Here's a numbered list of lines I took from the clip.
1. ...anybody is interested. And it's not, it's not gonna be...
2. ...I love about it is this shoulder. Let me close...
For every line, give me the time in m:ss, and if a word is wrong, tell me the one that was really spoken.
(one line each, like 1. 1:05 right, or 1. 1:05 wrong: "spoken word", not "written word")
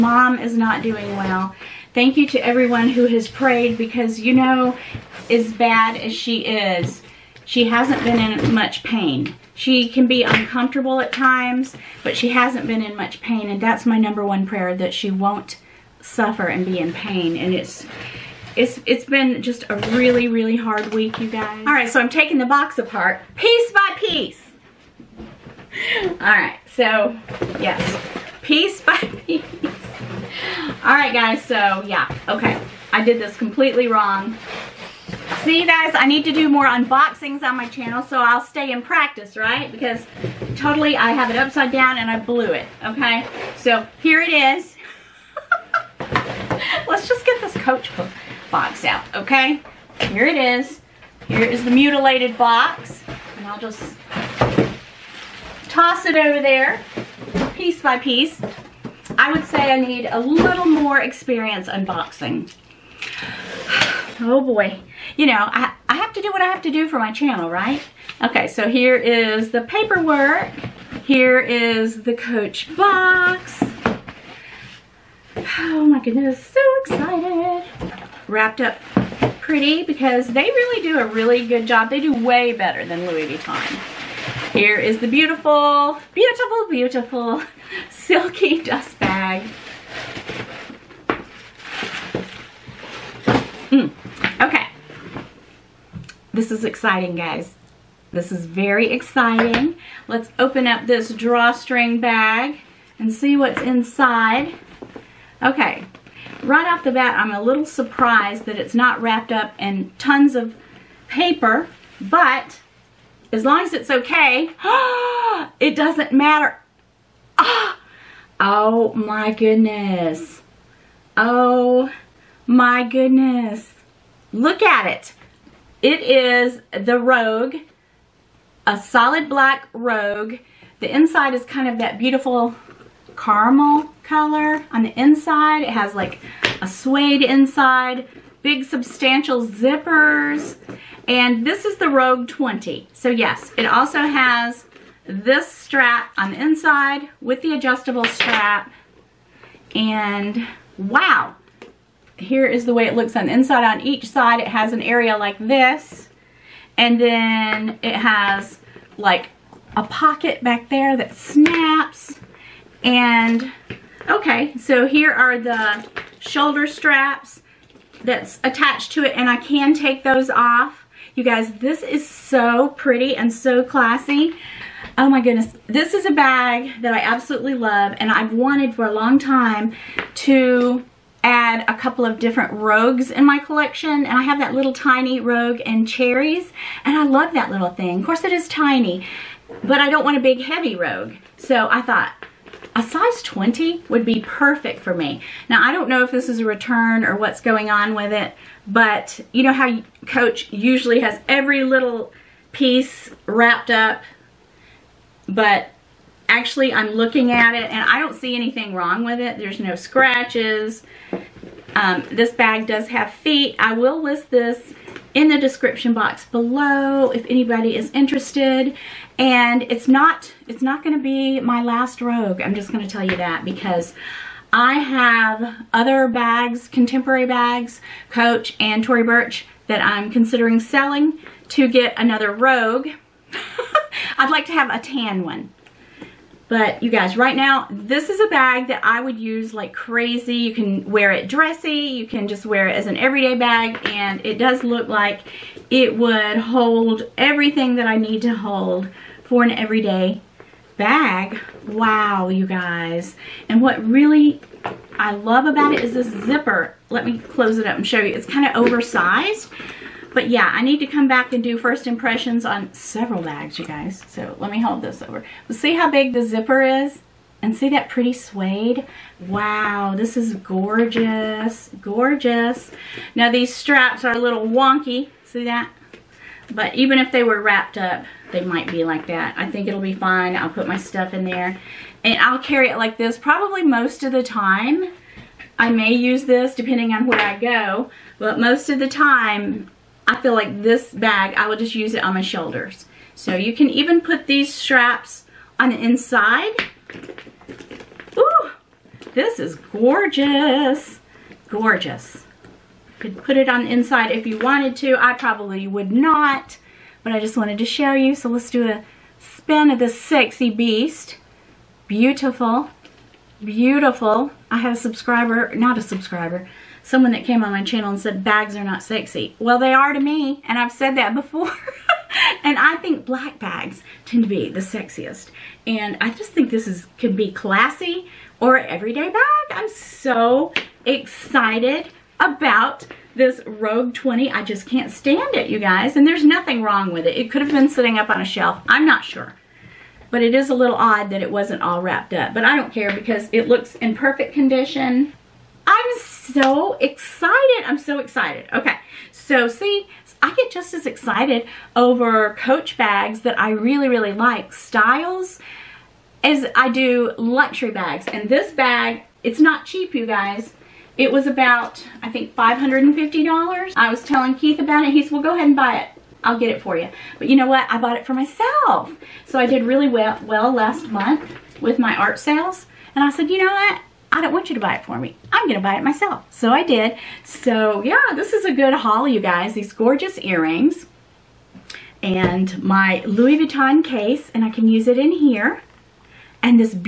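1. 3:37 right
2. 4:14 wrong: "zipper", not "shoulder".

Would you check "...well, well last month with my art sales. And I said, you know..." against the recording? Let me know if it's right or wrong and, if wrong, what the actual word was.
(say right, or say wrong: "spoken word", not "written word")
right.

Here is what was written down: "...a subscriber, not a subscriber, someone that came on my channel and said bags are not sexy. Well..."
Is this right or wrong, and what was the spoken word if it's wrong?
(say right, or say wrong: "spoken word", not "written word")
right.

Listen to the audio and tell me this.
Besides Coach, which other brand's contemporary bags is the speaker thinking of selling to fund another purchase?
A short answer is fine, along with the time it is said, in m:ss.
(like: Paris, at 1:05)
Tory Burch, at 3:48.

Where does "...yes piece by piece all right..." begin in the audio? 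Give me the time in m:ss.
0:27.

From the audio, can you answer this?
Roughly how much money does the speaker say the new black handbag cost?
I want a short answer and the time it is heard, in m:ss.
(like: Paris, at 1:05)
$550, at 6:02.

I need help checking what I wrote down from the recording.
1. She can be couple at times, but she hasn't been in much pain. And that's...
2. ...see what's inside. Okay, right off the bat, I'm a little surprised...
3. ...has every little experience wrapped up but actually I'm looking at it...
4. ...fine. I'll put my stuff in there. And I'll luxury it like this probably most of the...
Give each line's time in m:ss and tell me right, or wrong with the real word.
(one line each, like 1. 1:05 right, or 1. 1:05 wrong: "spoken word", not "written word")
1. 0:09 wrong: "uncomfortable", not "couple"
2. 1:43 right
3. 3:20 wrong: "piece", not "experience"
4. 4:39 wrong: "carry", not "luxury".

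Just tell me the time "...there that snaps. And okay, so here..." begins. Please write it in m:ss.
2:40.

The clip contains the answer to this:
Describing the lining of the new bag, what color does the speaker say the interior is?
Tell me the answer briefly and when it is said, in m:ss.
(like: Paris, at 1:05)
caramel, at 2:13.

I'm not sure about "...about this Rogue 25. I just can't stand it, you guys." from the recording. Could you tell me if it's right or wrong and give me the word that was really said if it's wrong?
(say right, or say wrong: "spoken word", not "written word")
wrong: "20", not "25".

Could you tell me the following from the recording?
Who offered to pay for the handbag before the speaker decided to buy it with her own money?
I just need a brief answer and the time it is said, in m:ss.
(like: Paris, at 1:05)
Keith, at 6:04.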